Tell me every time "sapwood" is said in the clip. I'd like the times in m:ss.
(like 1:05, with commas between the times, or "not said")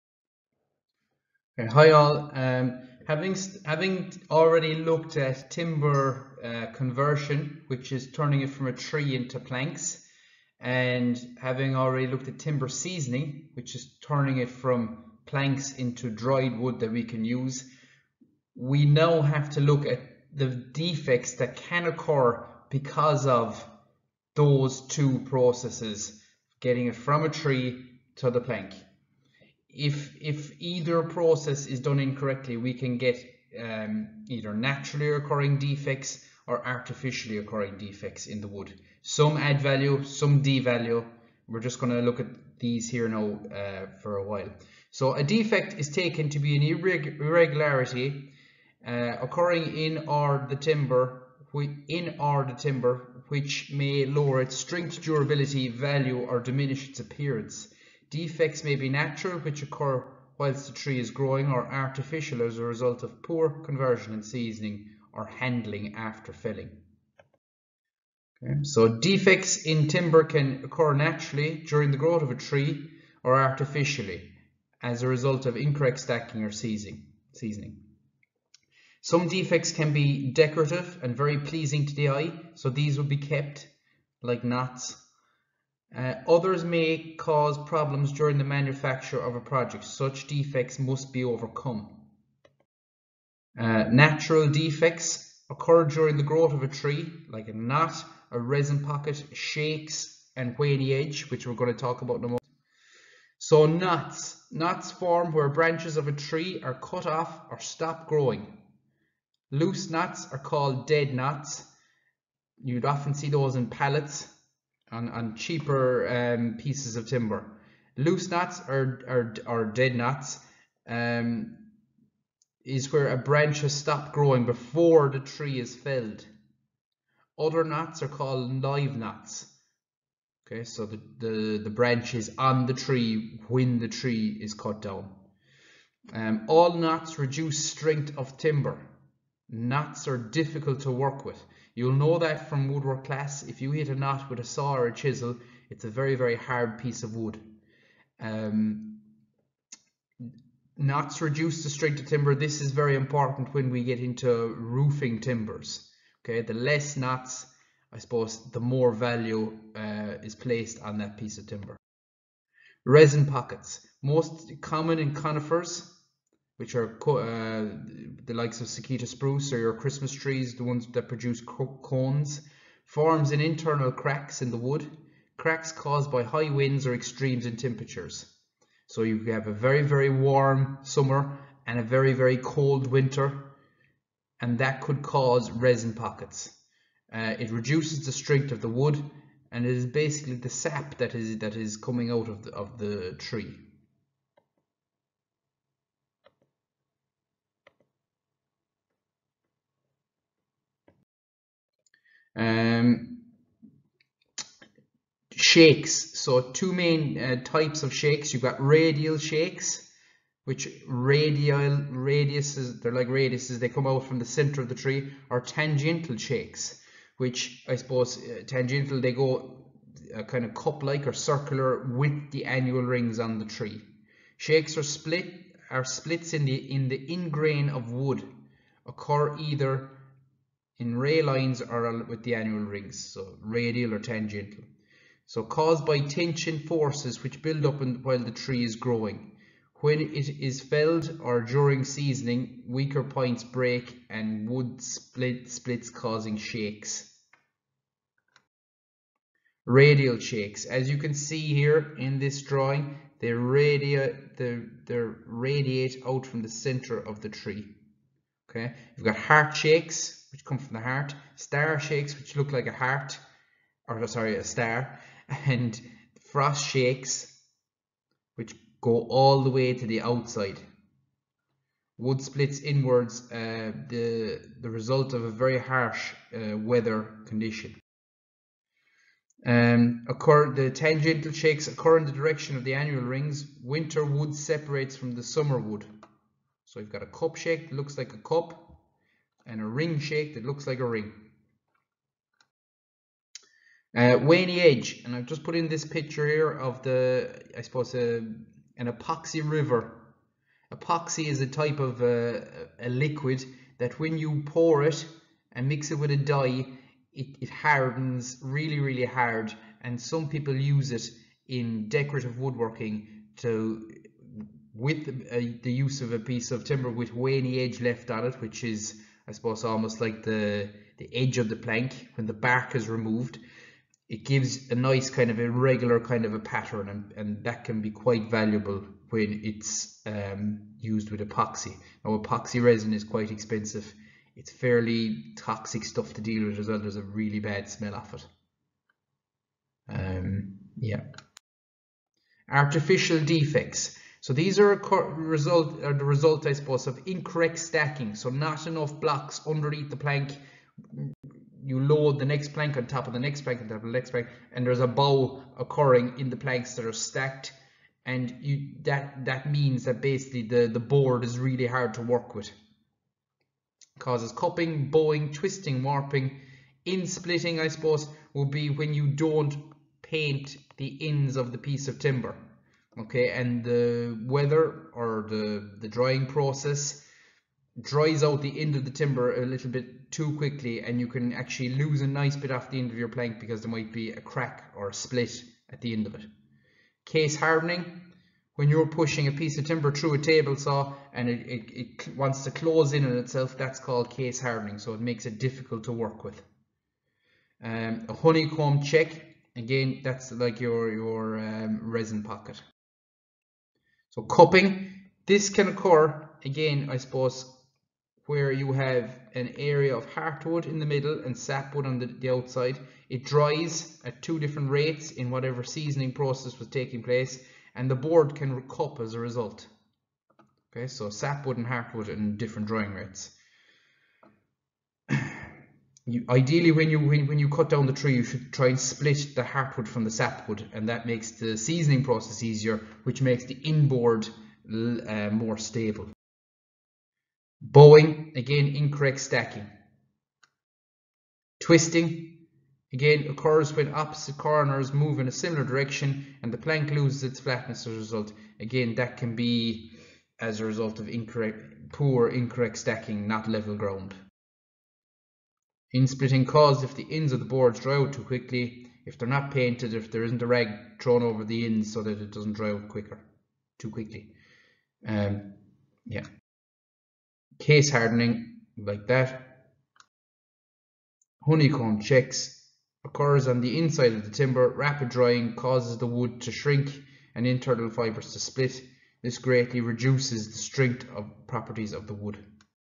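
6:51, 7:01, 7:10.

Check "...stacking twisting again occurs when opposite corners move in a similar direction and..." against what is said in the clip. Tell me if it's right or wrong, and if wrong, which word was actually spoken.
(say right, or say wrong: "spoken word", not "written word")
right.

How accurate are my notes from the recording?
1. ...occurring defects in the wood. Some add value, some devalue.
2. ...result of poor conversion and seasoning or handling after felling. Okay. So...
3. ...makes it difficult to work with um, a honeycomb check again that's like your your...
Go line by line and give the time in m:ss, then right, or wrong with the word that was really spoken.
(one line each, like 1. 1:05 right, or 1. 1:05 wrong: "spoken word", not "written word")
1. 0:37 right
2. 1:02 right
3. 6:34 right.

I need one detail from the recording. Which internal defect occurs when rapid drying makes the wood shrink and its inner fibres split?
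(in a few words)
Honeycomb checks.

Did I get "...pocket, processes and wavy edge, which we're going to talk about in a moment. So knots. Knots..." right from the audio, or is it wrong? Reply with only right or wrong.
wrong.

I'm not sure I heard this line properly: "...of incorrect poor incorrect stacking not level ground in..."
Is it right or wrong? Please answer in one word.
right.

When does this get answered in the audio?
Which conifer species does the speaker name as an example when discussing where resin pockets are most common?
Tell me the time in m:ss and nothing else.
2:48.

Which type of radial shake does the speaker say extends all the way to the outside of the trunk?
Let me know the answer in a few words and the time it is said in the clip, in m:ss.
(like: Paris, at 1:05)
frost shakes, at 4:26.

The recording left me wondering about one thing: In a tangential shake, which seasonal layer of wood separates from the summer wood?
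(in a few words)
Winter wood.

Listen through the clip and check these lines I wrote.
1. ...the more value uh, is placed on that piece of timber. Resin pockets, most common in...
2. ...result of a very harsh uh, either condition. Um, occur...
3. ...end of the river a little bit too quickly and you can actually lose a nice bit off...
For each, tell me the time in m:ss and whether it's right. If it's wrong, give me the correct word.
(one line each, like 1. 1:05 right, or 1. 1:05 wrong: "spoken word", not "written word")
1. 2:38 right
2. 4:34 wrong: "weather", not "either"
3. 6:18 wrong: "timber", not "river".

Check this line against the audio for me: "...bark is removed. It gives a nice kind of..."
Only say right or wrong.
right.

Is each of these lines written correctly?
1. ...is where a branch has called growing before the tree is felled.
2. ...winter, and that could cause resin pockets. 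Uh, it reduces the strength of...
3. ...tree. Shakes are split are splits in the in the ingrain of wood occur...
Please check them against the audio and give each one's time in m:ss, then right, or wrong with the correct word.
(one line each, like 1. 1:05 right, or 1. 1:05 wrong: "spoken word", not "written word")
1. 2:02 wrong: "stopped", not "called"
2. 3:02 right
3. 3:43 right.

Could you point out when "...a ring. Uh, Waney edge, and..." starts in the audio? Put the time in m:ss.
4:50.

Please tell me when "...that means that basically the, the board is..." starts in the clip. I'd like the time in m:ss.
5:59.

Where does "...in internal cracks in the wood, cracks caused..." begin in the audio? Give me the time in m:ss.
2:53.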